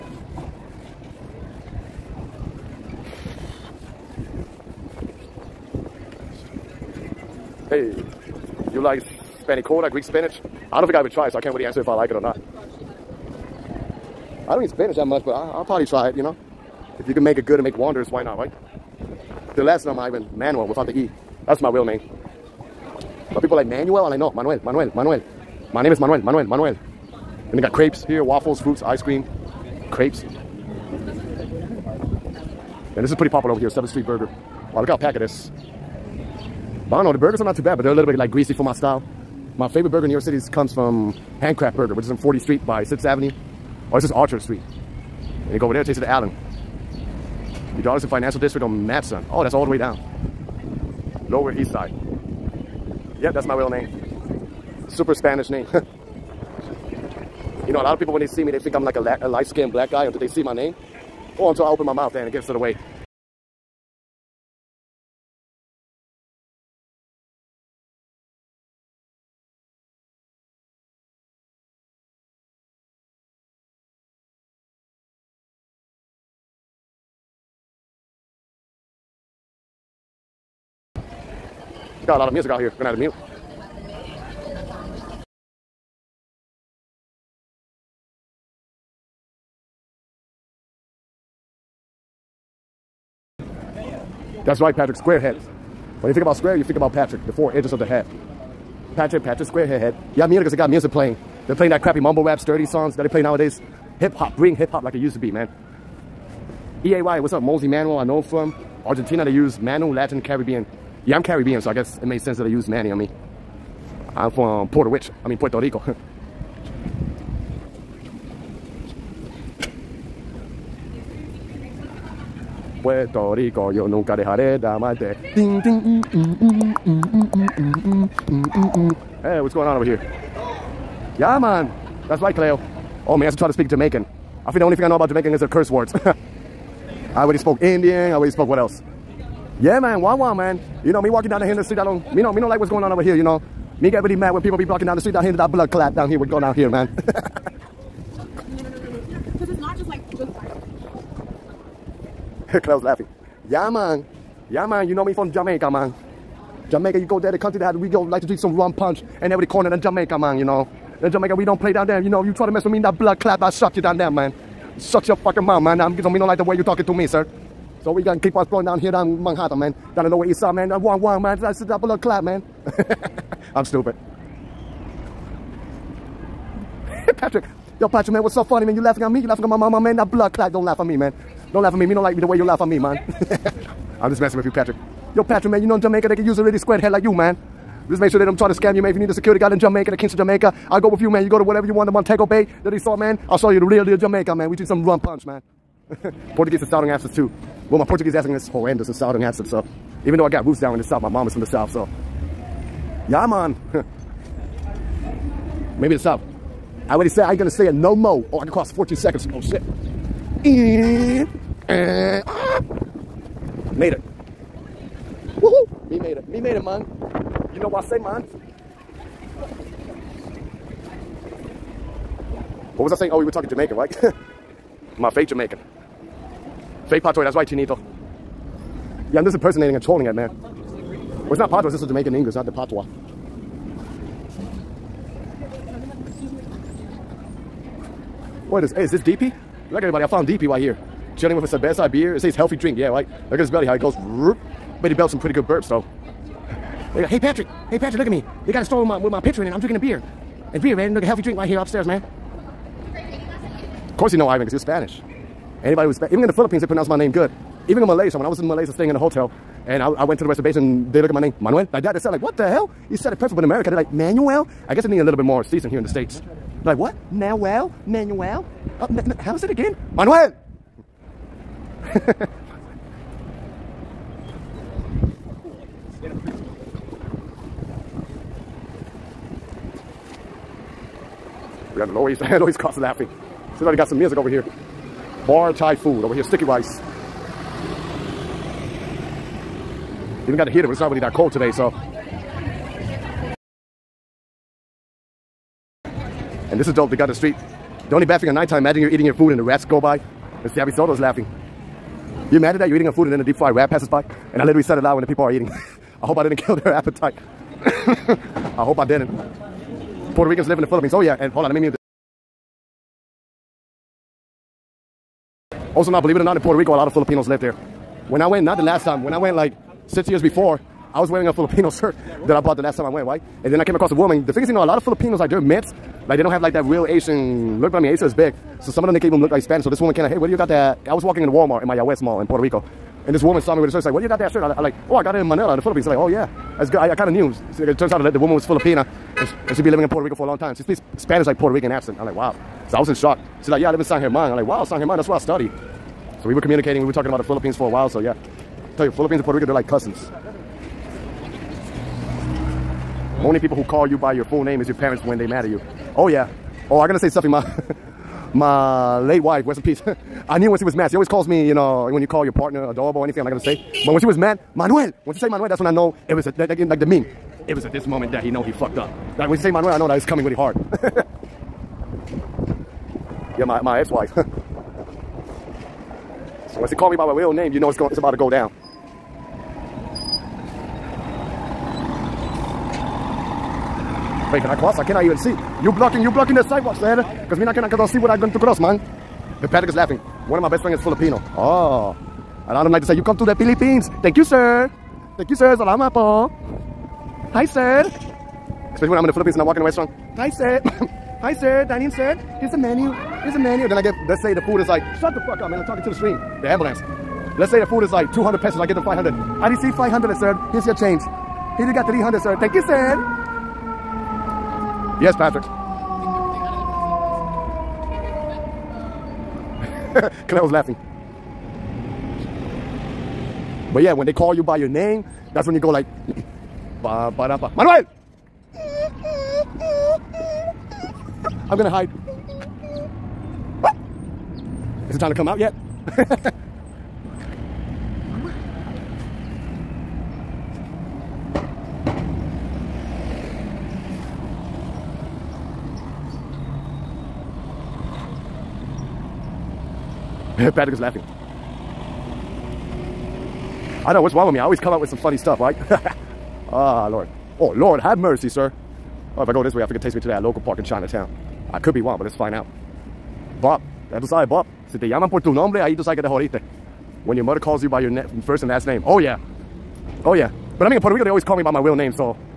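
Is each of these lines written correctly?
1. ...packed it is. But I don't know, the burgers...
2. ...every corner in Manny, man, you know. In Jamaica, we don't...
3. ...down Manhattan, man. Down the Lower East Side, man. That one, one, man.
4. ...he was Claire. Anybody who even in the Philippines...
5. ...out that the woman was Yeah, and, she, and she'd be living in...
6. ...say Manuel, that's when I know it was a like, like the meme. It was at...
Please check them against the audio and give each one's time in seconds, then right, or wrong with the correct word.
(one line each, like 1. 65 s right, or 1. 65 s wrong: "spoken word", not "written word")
1. 34 s right
2. 159 s wrong: "Jamaica", not "Manny"
3. 168 s right
4. 254 s wrong: "Spanish", not "Claire"
5. 337 s wrong: "Filipina", not "Yeah"
6. 365 s right.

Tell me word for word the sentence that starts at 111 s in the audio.
Yeah, I'm Caribbean, so I guess it made sense that they used Manny on me.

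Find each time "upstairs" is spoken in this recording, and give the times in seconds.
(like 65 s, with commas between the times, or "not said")
251 s.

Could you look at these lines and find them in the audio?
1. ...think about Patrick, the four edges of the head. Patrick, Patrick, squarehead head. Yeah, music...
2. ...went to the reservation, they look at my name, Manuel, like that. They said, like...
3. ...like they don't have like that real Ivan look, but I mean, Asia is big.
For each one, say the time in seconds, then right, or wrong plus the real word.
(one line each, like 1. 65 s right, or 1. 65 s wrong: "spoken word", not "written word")
1. 96 s right
2. 260 s right
3. 326 s wrong: "Asian", not "Ivan".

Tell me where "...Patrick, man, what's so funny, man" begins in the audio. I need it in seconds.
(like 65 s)
177 s.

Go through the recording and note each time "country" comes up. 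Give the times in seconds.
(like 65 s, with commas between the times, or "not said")
157 s.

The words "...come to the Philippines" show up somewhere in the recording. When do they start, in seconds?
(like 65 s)
393 s.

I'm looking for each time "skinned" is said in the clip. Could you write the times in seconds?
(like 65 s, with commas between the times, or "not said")
59 s.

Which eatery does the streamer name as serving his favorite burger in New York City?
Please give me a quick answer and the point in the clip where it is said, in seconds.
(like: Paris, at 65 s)
Handcraft Burger, at 41 s.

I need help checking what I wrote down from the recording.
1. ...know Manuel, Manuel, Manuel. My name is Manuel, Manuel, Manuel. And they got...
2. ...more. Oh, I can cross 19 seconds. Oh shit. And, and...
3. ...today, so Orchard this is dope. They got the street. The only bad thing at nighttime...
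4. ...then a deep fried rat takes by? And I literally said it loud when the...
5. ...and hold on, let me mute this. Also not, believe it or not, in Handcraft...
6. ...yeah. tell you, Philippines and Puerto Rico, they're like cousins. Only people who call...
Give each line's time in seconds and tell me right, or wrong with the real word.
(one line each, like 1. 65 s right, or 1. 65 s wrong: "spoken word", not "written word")
1. 24 s right
2. 207 s wrong: "14", not "19"
3. 291 s wrong: "And", not "Orchard"
4. 303 s wrong: "passes", not "takes"
5. 311 s wrong: "Puerto", not "Handcraft"
6. 347 s right.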